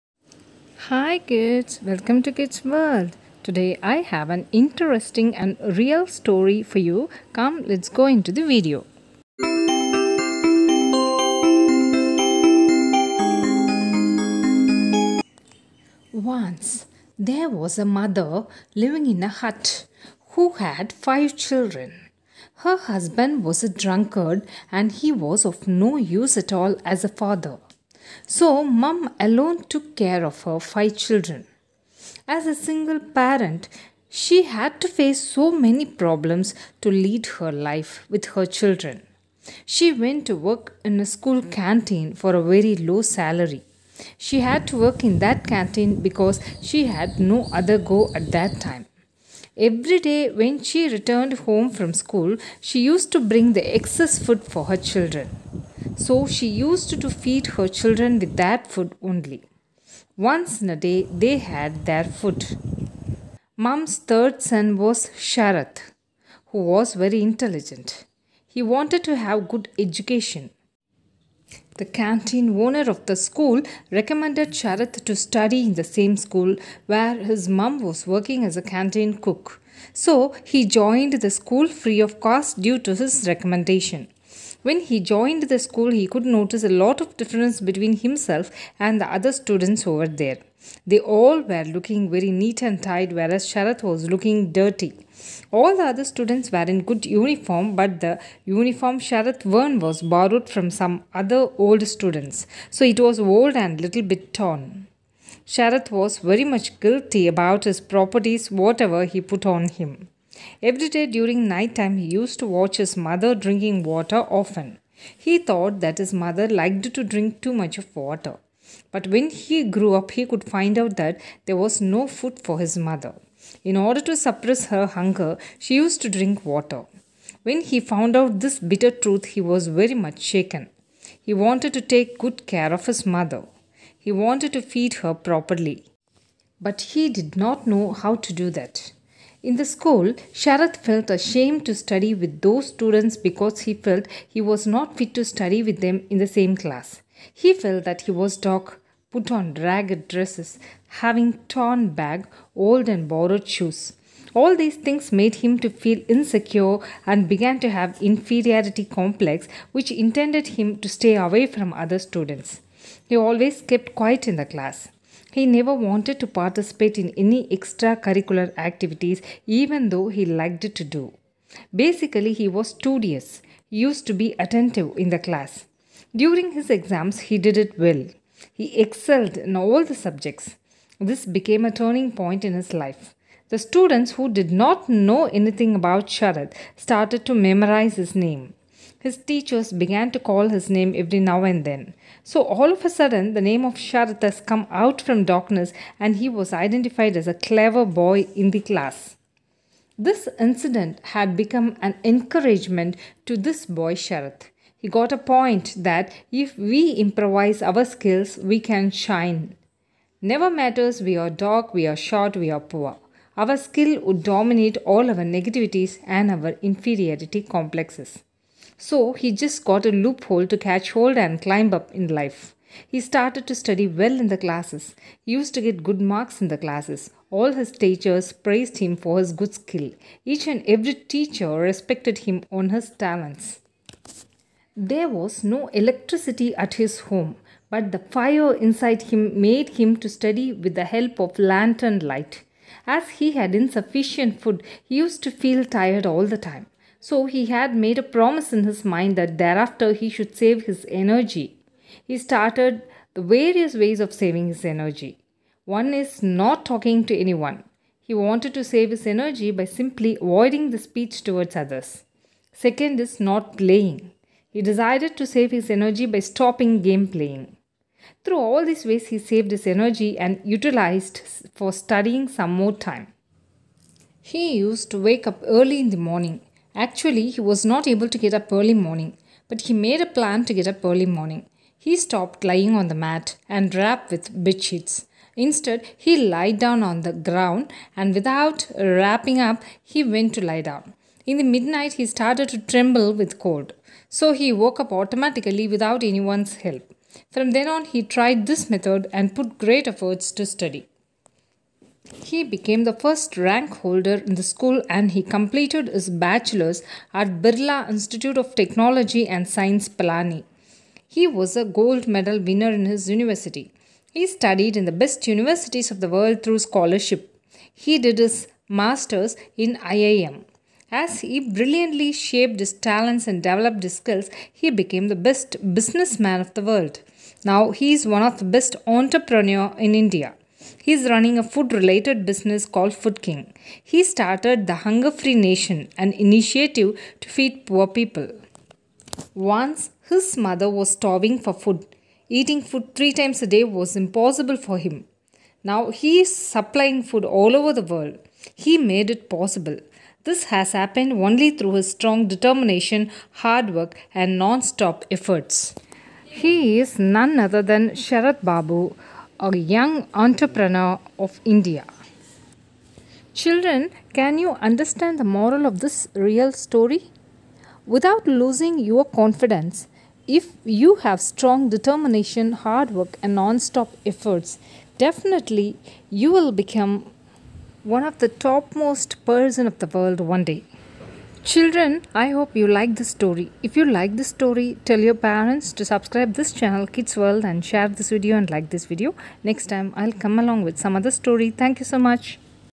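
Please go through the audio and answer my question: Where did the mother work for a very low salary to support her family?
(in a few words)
School canteen.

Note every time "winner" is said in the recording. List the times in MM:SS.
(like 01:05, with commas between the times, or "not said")
05:12.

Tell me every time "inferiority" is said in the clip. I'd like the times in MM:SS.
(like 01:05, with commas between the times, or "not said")
02:38, 03:36.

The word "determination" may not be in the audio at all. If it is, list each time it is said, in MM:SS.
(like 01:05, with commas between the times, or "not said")
05:52, 06:11.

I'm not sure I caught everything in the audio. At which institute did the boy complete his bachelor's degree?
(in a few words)
Birla Institute of Technology and Science Pilani.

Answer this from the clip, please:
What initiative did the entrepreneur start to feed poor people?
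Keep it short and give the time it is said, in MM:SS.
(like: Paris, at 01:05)
Hunger Free Nation, at 05:34.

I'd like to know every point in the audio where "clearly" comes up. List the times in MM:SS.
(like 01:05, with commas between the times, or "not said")
not said.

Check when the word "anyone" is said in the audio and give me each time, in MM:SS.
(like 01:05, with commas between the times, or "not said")
04:17, 04:56.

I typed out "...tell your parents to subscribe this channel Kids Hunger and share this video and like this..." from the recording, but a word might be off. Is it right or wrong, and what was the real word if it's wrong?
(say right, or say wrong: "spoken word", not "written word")
wrong: "World", not "Hunger".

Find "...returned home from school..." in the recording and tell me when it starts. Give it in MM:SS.
00:50.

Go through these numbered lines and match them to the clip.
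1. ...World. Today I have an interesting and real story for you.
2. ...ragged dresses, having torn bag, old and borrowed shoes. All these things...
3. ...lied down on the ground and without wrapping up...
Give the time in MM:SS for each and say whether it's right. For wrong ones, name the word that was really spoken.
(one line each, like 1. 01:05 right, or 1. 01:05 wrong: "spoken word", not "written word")
1. 00:02 right
2. 02:29 right
3. 04:46 right.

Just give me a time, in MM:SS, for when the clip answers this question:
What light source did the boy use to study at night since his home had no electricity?
04:01.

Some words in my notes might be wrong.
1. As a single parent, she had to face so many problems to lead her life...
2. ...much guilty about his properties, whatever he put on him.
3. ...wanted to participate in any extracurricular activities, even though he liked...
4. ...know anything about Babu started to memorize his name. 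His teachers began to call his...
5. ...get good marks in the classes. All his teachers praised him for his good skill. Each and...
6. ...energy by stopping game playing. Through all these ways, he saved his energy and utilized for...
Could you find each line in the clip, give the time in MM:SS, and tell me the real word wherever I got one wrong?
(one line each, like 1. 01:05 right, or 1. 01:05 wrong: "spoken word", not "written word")
1. 00:32 right
2. 01:46 right
3. 02:45 right
4. 03:04 wrong: "Sharad", not "Babu"
5. 03:45 right
6. 04:25 right.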